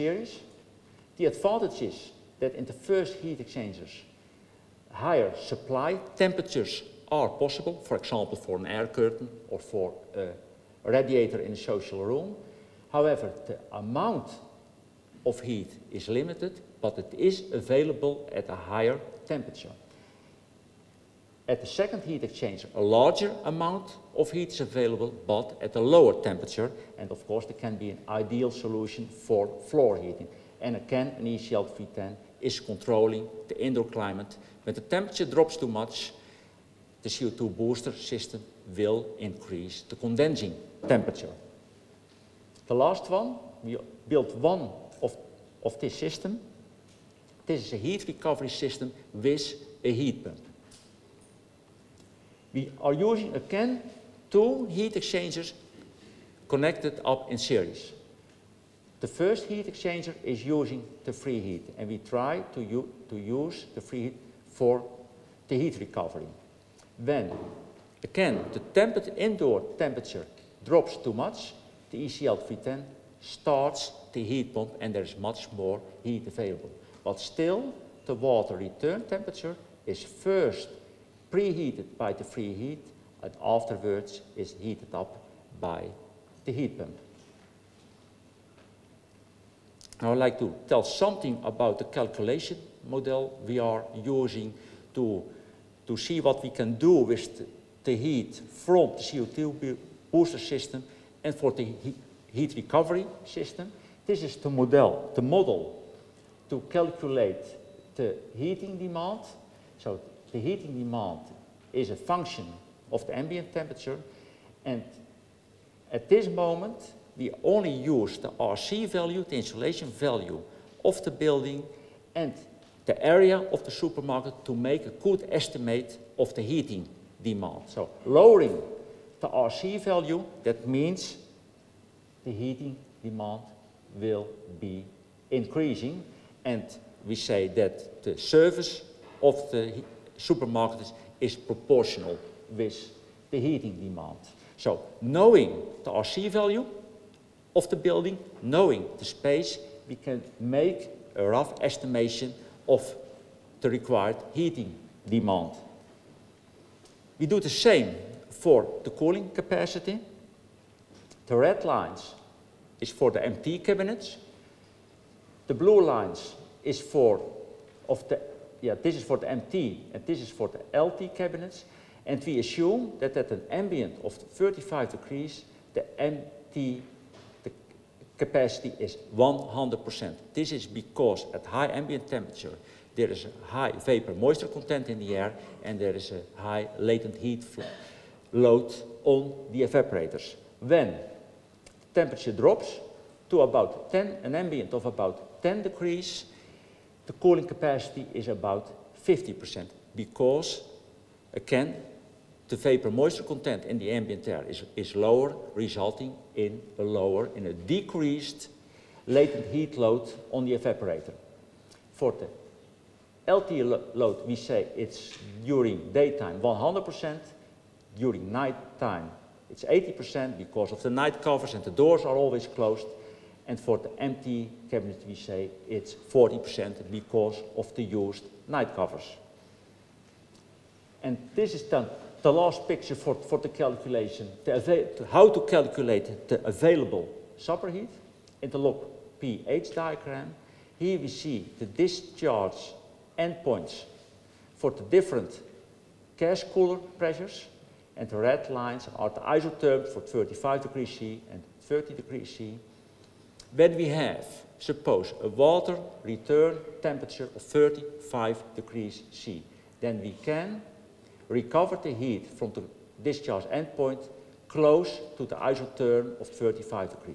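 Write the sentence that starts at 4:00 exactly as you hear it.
Here we see the discharge endpoints for the different gas cooler pressures.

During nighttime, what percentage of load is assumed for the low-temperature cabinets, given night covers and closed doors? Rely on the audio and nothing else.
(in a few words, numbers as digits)
80%.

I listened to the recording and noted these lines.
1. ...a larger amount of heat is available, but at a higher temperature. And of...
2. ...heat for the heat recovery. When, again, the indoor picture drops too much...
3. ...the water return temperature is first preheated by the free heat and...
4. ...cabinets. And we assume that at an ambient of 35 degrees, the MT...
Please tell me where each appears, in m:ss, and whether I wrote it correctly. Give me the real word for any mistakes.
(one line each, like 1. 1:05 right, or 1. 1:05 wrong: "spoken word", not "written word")
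1. 0:22 wrong: "lower", not "higher"
2. 1:04 wrong: "temperature", not "picture"
3. 1:18 right
4. 2:51 right.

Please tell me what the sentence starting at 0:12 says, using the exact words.
However, the amount of heat is limited, but it is available at a higher temperature.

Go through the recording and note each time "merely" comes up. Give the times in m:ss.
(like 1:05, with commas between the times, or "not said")
not said.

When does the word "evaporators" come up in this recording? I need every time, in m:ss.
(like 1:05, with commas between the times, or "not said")
3:09, 3:30.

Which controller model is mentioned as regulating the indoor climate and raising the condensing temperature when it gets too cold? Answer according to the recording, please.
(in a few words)
ECL V10.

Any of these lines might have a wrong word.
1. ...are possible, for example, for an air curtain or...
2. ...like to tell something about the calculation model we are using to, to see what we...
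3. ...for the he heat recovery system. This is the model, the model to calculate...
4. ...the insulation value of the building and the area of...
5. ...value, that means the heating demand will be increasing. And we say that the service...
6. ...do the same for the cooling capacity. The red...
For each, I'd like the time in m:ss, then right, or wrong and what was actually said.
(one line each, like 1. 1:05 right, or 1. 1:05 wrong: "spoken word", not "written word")
1. 0:07 right
2. 1:30 right
3. 1:41 right
4. 1:59 right
5. 2:09 right
6. 2:37 right.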